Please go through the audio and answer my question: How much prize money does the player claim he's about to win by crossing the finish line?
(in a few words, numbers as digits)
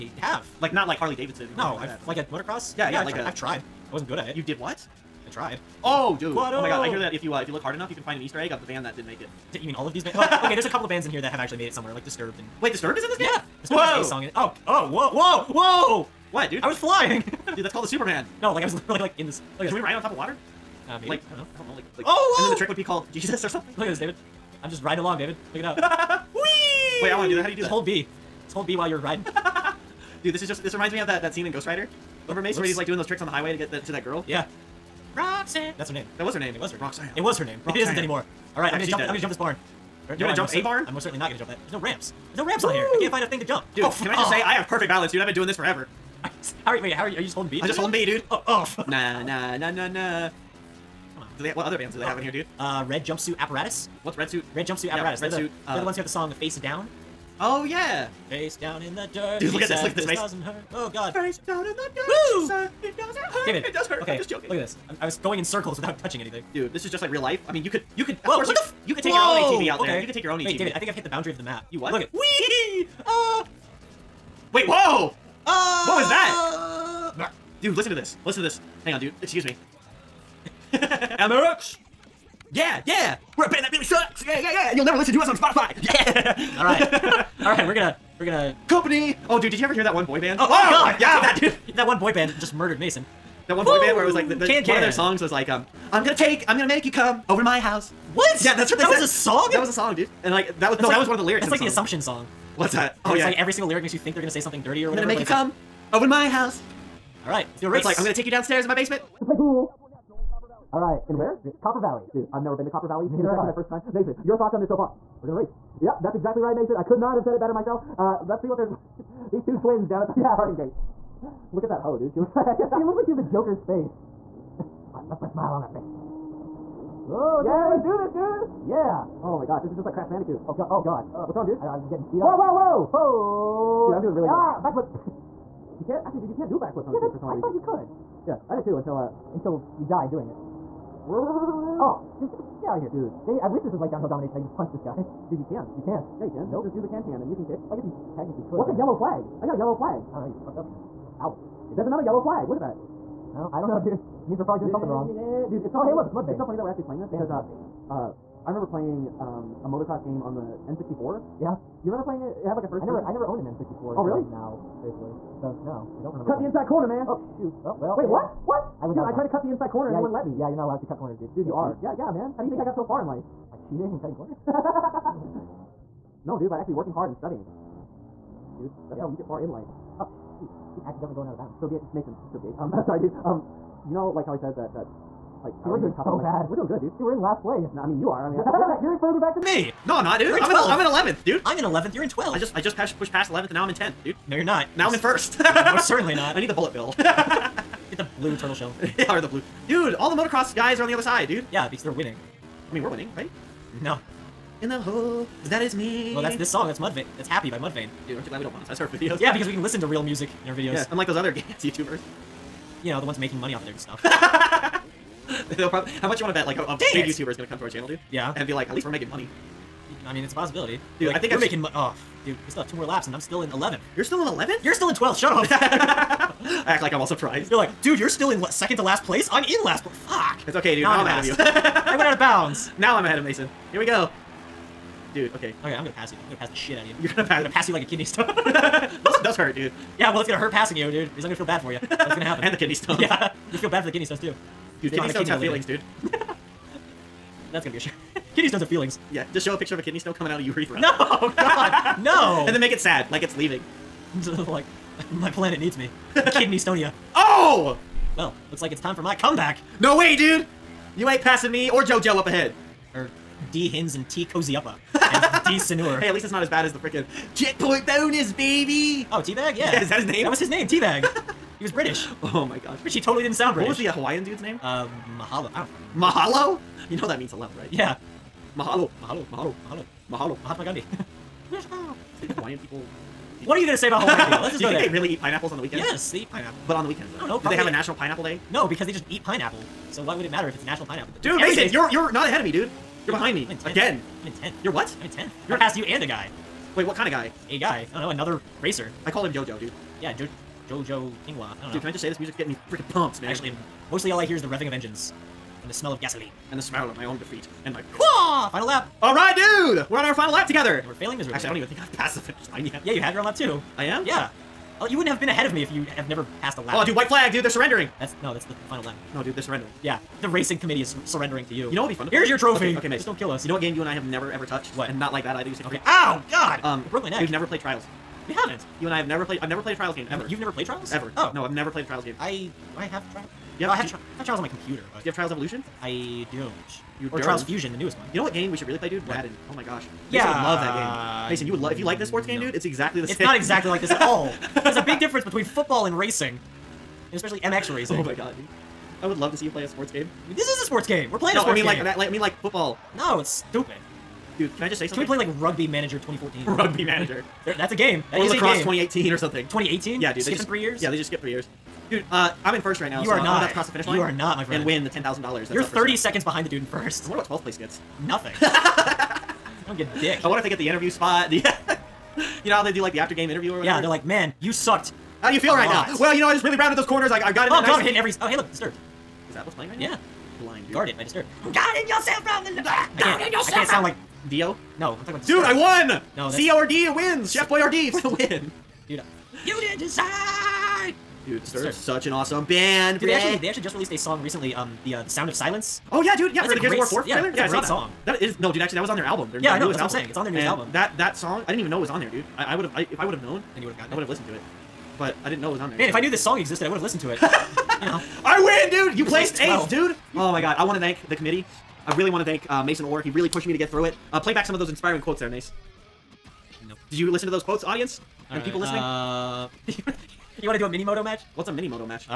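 $10,000.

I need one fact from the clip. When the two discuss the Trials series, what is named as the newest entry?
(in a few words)
Trials Fusion.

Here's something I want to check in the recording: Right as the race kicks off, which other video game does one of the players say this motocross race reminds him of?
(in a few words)
Crash Bandicoot.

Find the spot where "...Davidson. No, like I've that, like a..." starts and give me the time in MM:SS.
00:01.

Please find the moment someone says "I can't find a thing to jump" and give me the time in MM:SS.
00:42.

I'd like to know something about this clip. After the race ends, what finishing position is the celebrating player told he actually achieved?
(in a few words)
8th.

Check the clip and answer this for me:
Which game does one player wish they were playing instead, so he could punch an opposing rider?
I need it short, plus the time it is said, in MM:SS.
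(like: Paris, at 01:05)
Downhill Domination, at 02:23.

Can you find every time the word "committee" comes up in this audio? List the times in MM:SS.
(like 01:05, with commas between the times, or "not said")
05:20, 06:51.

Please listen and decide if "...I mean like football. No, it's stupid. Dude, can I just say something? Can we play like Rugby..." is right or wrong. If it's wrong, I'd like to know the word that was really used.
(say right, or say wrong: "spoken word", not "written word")
right.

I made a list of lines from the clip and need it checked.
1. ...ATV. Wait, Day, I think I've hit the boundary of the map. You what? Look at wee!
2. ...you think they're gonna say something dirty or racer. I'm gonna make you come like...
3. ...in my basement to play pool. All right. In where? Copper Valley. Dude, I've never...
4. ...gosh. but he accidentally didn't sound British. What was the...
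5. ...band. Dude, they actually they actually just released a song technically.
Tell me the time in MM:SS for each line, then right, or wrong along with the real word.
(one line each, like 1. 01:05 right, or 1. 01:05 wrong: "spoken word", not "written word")
1. 01:10 wrong: "David", not "Day"
2. 01:43 wrong: "whatever", not "racer"
3. 01:48 right
4. 04:32 wrong: "totally", not "accidentally"
5. 06:32 wrong: "recently", not "technically".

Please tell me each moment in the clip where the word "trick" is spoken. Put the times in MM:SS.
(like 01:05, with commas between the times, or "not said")
00:22, 00:33.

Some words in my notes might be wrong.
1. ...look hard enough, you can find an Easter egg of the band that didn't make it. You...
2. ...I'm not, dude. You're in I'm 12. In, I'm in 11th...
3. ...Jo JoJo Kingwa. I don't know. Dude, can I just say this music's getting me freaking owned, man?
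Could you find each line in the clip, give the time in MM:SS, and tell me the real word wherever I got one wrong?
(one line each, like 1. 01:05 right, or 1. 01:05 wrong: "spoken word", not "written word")
1. 00:07 right
2. 03:09 right
3. 05:00 wrong: "pumped", not "owned".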